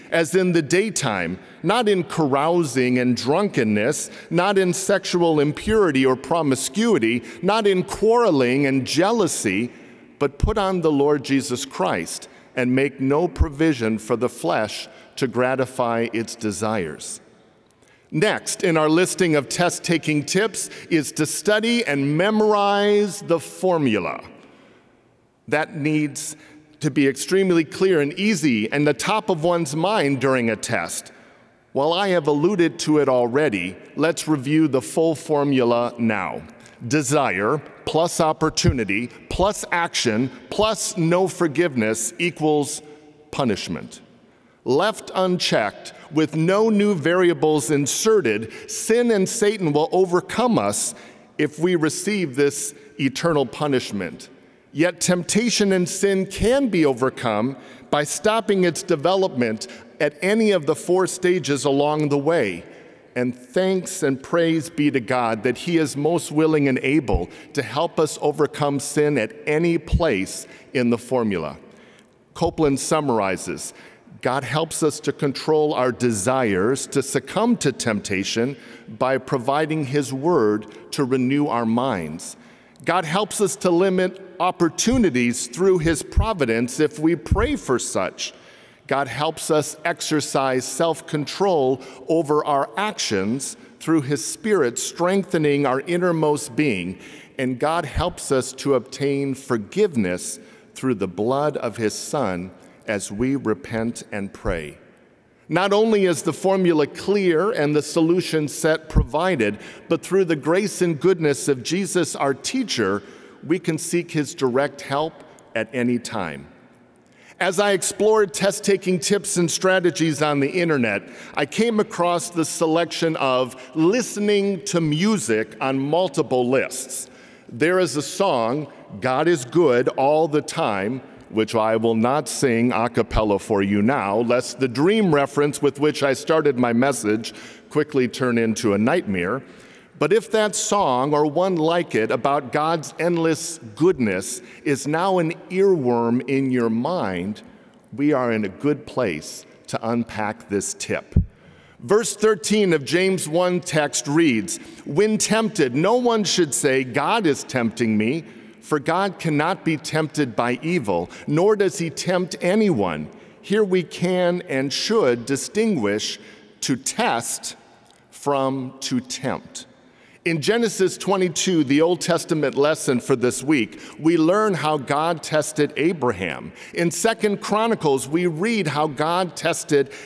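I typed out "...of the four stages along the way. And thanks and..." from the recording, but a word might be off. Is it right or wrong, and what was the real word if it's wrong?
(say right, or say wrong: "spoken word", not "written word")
right.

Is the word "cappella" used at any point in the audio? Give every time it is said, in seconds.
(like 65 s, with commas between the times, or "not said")
132 s.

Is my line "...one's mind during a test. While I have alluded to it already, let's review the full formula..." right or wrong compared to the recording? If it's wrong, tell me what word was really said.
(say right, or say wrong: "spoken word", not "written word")
right.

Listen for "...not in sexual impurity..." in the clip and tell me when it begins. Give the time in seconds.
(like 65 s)
4 s.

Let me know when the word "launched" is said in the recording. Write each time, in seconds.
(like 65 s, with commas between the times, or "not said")
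not said.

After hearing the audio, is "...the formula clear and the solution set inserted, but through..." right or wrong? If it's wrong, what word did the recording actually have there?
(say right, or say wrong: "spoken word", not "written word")
wrong: "provided", not "inserted".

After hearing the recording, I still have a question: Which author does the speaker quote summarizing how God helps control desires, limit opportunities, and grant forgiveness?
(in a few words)
Copeland.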